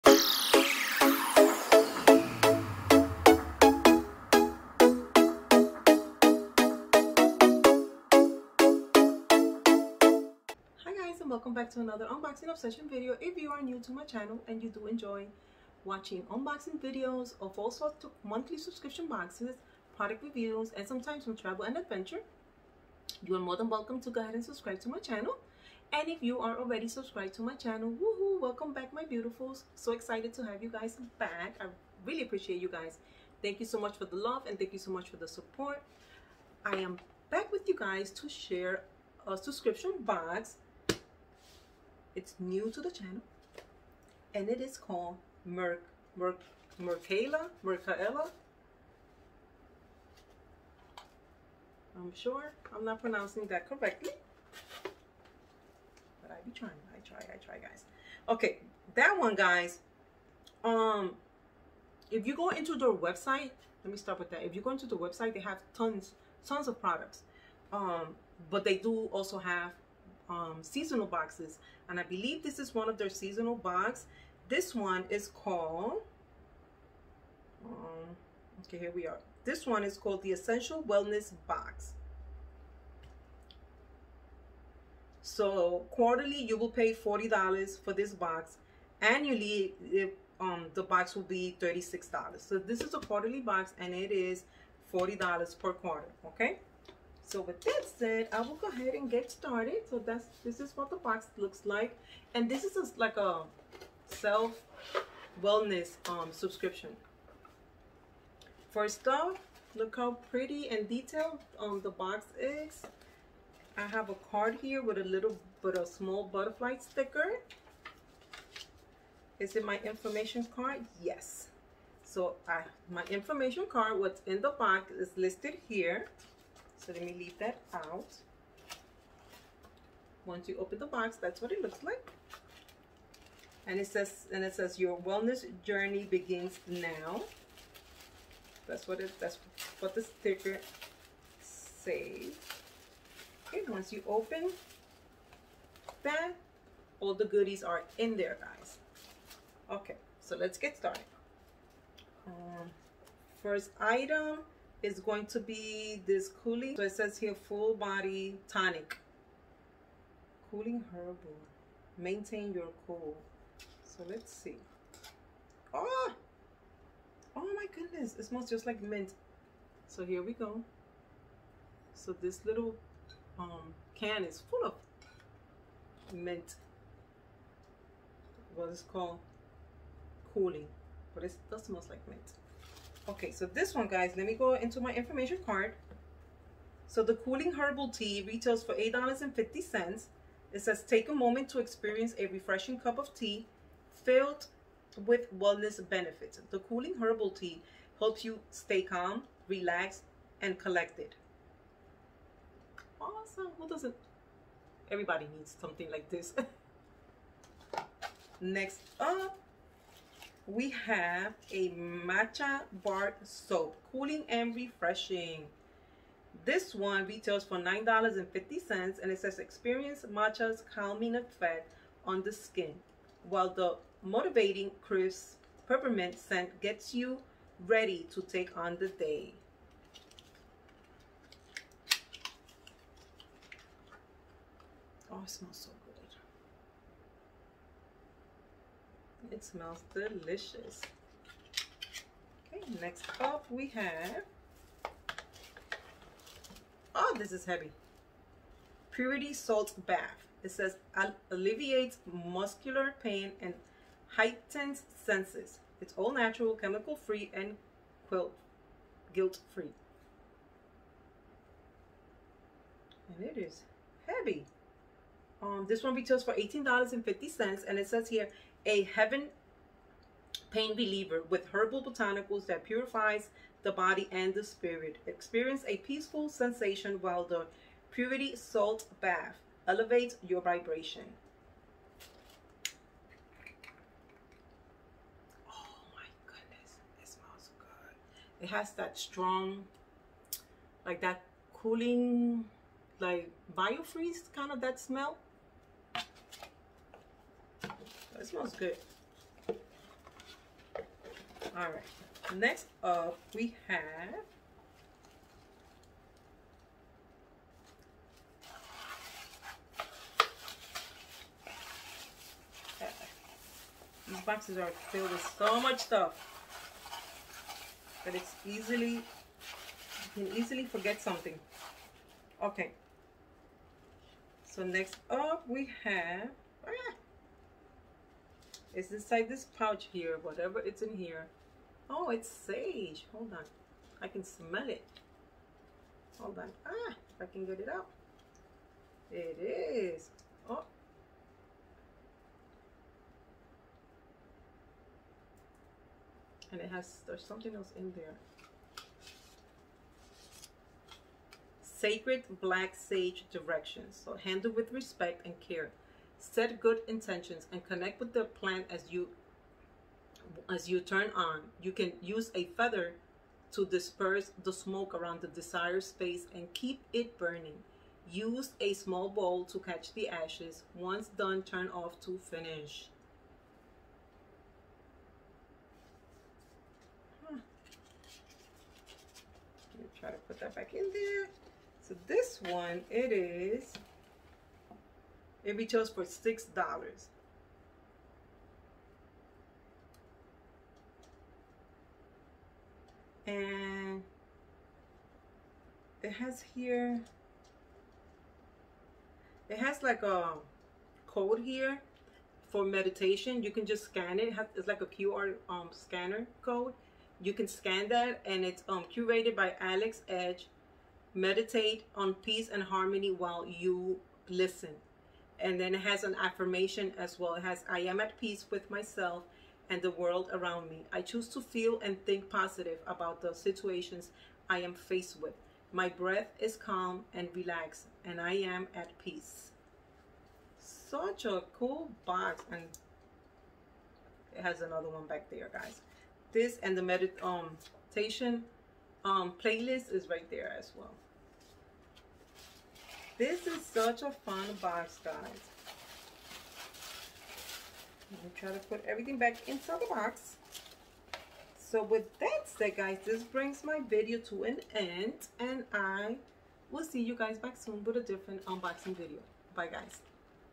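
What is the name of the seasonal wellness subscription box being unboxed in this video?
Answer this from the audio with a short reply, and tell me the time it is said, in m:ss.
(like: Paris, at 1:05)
Essential Wellness Box, at 1:20.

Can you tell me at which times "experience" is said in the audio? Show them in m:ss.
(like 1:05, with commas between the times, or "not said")
3:11, 3:39, 4:35.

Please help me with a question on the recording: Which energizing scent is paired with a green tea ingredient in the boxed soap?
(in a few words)
peppermint.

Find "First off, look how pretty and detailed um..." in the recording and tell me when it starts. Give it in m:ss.
1:48.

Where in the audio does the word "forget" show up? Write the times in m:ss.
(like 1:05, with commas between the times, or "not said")
5:20.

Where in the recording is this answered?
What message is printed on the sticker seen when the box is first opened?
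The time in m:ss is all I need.
2:14.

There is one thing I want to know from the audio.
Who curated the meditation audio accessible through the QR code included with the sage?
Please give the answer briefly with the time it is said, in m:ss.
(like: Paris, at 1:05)
Alex Edge, at 6:49.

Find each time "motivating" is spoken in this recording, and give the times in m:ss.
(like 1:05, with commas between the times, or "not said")
3:44.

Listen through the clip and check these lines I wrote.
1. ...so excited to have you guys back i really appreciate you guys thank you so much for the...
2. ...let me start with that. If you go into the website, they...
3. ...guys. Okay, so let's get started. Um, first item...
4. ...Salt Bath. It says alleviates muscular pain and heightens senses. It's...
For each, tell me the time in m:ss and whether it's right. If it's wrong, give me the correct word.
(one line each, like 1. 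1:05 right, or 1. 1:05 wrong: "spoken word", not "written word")
1. 0:29 right
2. 1:03 right
3. 2:28 right
4. 4:09 right.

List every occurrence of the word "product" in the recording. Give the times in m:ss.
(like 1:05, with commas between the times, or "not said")
0:19, 1:06.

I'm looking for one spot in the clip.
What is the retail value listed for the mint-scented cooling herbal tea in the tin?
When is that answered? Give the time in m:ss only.
3:08.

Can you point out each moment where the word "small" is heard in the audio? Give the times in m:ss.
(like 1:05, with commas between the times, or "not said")
1:55, 6:08.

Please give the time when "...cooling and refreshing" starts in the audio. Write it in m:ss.
3:33.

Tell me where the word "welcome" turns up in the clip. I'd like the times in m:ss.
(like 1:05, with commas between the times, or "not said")
0:11, 0:23, 0:28.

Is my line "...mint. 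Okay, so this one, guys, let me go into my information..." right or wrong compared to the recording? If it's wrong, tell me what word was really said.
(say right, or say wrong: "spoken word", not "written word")
right.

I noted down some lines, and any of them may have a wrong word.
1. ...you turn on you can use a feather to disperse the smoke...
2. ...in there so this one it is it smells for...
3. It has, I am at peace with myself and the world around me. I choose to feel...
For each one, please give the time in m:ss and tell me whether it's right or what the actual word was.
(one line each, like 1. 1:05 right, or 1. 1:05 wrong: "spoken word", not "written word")
1. 6:00 right
2. 6:20 wrong: "retails", not "smells"
3. 6:57 right.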